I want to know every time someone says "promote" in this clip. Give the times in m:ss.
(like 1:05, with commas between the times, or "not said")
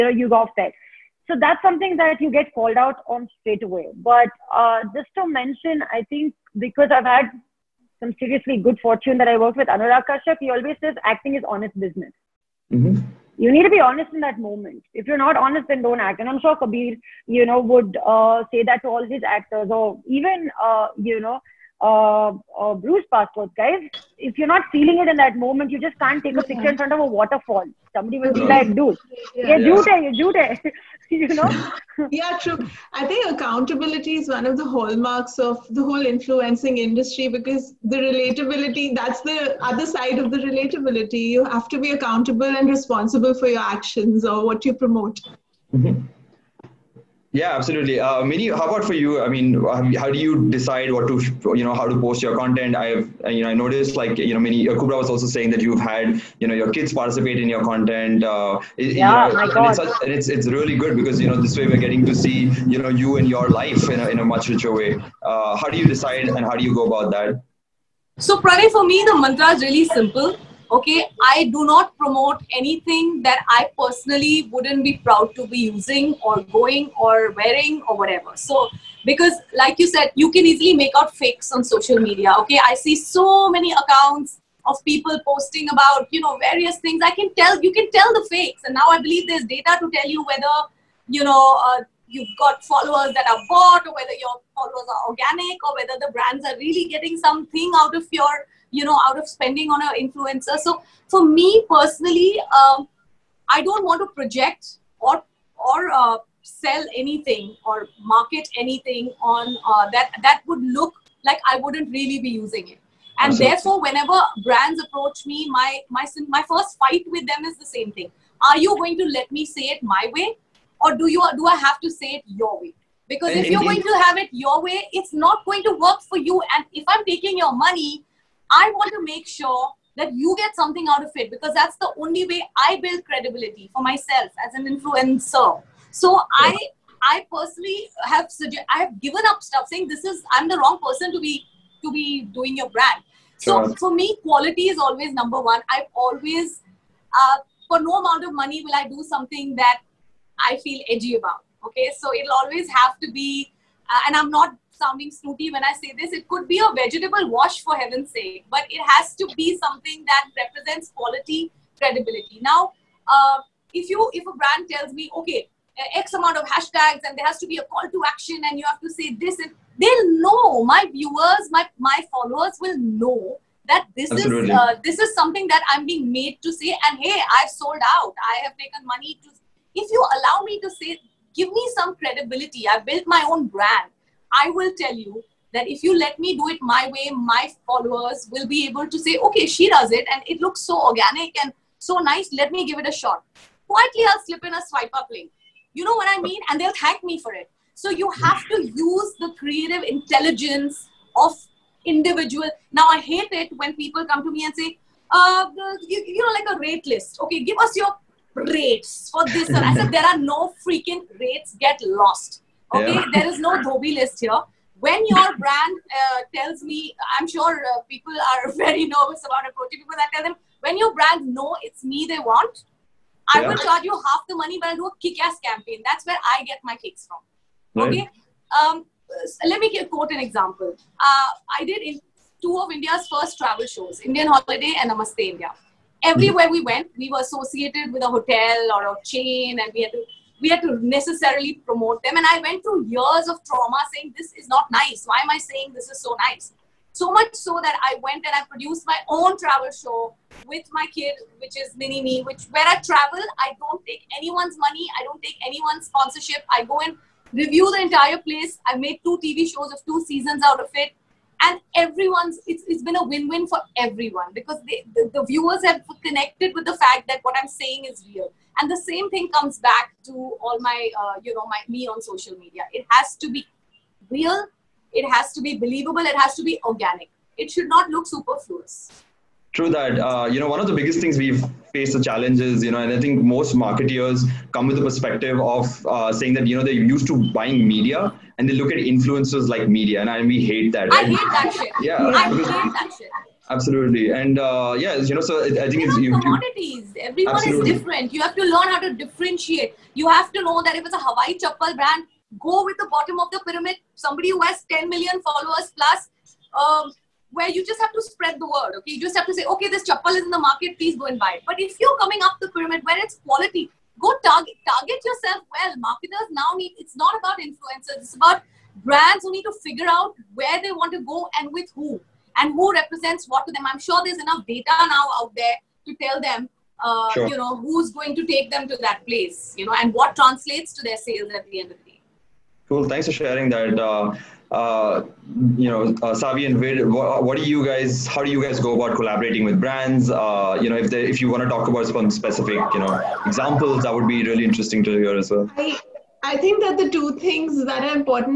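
0:44, 1:11, 4:01.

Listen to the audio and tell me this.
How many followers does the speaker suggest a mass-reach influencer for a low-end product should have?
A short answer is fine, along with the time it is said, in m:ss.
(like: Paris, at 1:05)
10 million plus, at 5:04.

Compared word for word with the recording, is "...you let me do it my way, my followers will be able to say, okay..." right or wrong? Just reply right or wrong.
right.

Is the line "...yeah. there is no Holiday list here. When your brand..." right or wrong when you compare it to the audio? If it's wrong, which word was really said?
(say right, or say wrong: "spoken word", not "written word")
wrong: "Dhobi", not "Holiday".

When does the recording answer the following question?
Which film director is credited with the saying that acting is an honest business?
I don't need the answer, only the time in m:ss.
0:09.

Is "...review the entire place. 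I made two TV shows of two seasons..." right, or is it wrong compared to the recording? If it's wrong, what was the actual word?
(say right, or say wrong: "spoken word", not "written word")
right.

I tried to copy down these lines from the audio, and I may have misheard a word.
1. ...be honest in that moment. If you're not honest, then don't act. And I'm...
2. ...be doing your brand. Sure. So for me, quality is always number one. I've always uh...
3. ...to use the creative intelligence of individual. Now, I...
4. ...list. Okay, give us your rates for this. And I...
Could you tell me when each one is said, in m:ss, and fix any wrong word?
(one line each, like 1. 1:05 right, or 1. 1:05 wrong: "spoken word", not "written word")
1. 0:13 right
2. 2:21 right
3. 3:18 right
4. 3:26 right.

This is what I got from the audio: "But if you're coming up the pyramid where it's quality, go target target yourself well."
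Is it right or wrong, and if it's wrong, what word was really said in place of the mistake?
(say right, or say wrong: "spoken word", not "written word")
right.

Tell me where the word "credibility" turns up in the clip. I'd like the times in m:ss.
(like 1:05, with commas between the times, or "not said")
2:13, 2:41, 3:01.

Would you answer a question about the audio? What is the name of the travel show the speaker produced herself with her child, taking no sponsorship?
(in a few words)
Mini Me.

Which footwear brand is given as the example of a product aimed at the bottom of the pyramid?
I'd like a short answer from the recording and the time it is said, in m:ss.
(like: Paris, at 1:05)
Hawaii chappal, at 5:01.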